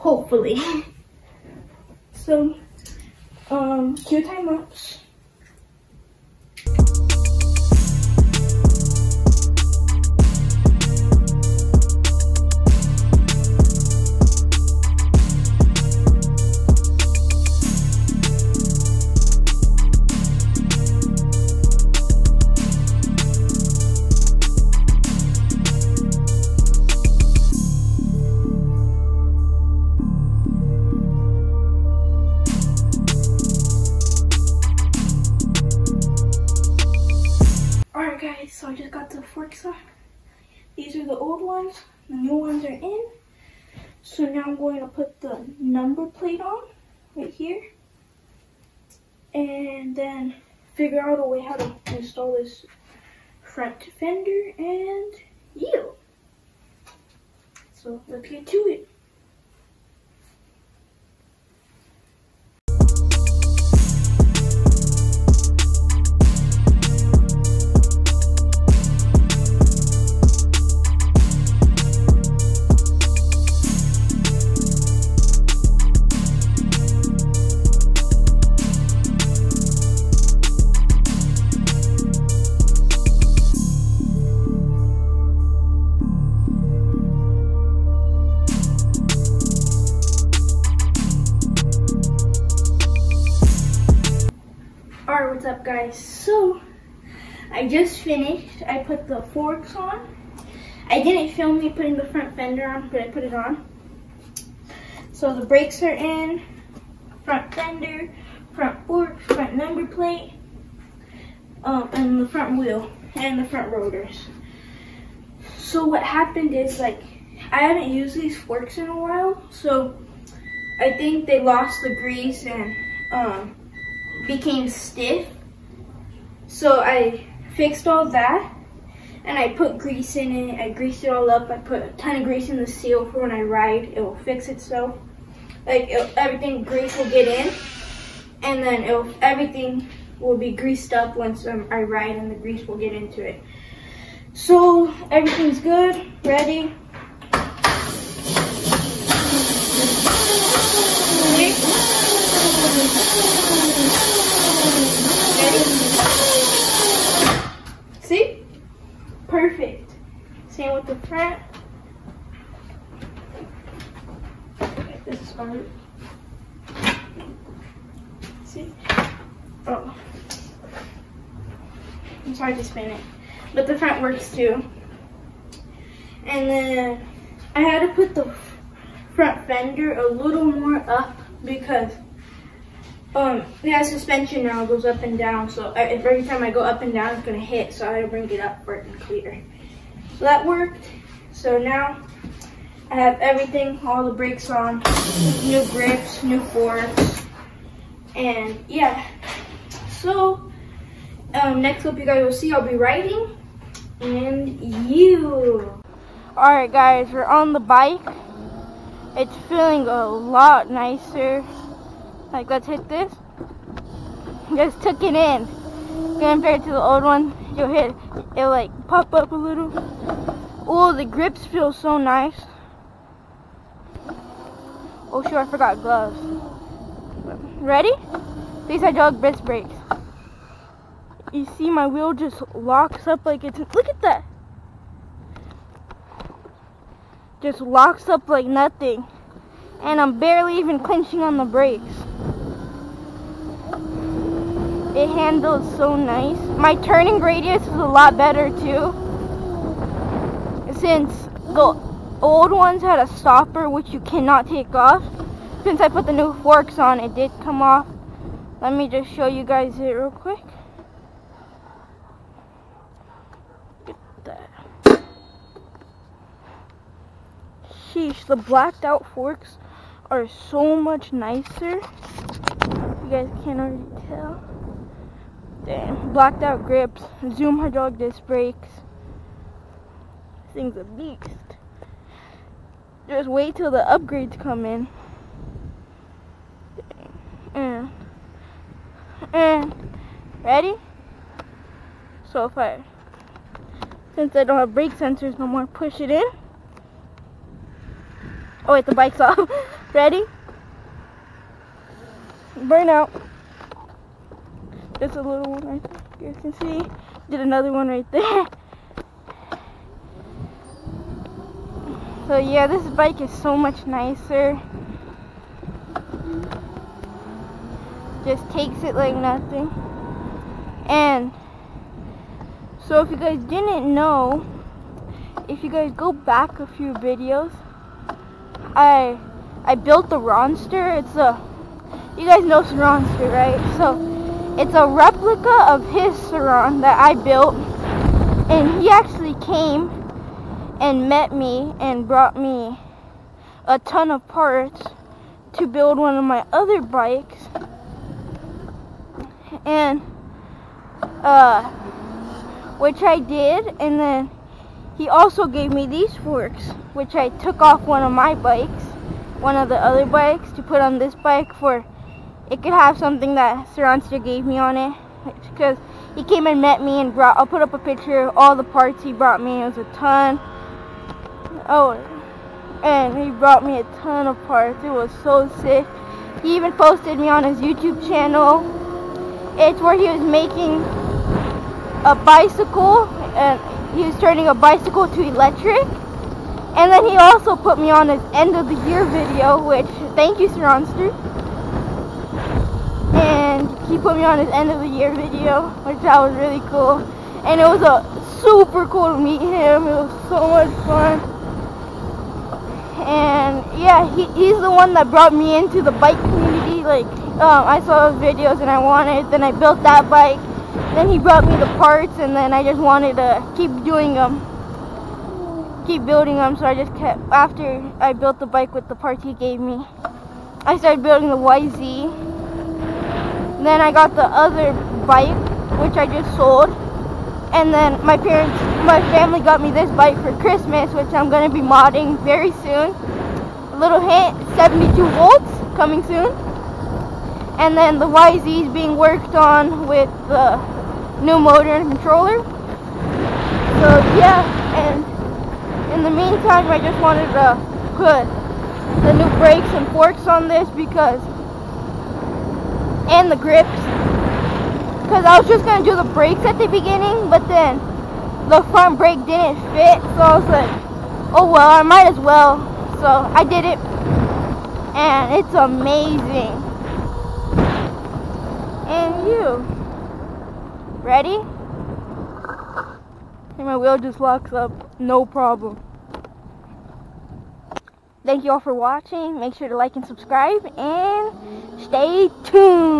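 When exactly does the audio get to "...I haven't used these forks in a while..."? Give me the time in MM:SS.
01:57.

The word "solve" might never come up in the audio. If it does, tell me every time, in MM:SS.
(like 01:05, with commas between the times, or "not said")
not said.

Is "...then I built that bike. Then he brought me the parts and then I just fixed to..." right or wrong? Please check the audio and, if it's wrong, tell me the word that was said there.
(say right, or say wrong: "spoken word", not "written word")
wrong: "wanted", not "fixed".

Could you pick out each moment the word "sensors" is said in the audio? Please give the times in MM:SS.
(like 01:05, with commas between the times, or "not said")
04:54.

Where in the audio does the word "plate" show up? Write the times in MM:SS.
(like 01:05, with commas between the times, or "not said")
00:46, 01:49.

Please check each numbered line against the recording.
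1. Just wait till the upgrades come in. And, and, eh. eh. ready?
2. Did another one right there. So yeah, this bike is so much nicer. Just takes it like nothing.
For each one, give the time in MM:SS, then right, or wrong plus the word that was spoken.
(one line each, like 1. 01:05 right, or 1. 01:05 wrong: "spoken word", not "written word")
1. 04:43 right
2. 05:07 right.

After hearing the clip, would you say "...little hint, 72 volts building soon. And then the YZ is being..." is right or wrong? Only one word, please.
wrong.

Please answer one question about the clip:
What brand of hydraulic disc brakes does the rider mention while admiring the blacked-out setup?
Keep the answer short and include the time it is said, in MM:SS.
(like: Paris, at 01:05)
Zoom, at 04:37.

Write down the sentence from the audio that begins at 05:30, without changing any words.
It's a you guys know Ronster, right?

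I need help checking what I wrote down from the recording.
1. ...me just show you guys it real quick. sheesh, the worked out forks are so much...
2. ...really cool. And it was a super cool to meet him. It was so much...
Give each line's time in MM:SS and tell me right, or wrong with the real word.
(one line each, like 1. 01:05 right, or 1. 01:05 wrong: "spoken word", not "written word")
1. 04:18 wrong: "blacked", not "worked"
2. 06:36 right.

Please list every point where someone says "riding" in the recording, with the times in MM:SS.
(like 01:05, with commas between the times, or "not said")
03:22.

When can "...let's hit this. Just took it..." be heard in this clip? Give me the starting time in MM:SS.
03:32.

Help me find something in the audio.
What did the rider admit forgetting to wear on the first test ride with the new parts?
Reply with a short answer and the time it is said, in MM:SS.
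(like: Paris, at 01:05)
Gloves, at 03:45.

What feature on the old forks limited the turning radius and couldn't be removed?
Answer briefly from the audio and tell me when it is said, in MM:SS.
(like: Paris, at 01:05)
A stopper, at 04:13.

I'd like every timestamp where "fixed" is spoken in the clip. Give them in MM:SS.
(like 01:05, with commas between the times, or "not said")
02:07.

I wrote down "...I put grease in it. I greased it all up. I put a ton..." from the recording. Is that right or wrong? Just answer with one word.
right.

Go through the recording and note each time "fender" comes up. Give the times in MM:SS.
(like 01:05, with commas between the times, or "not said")
00:53, 01:42, 01:47, 02:59.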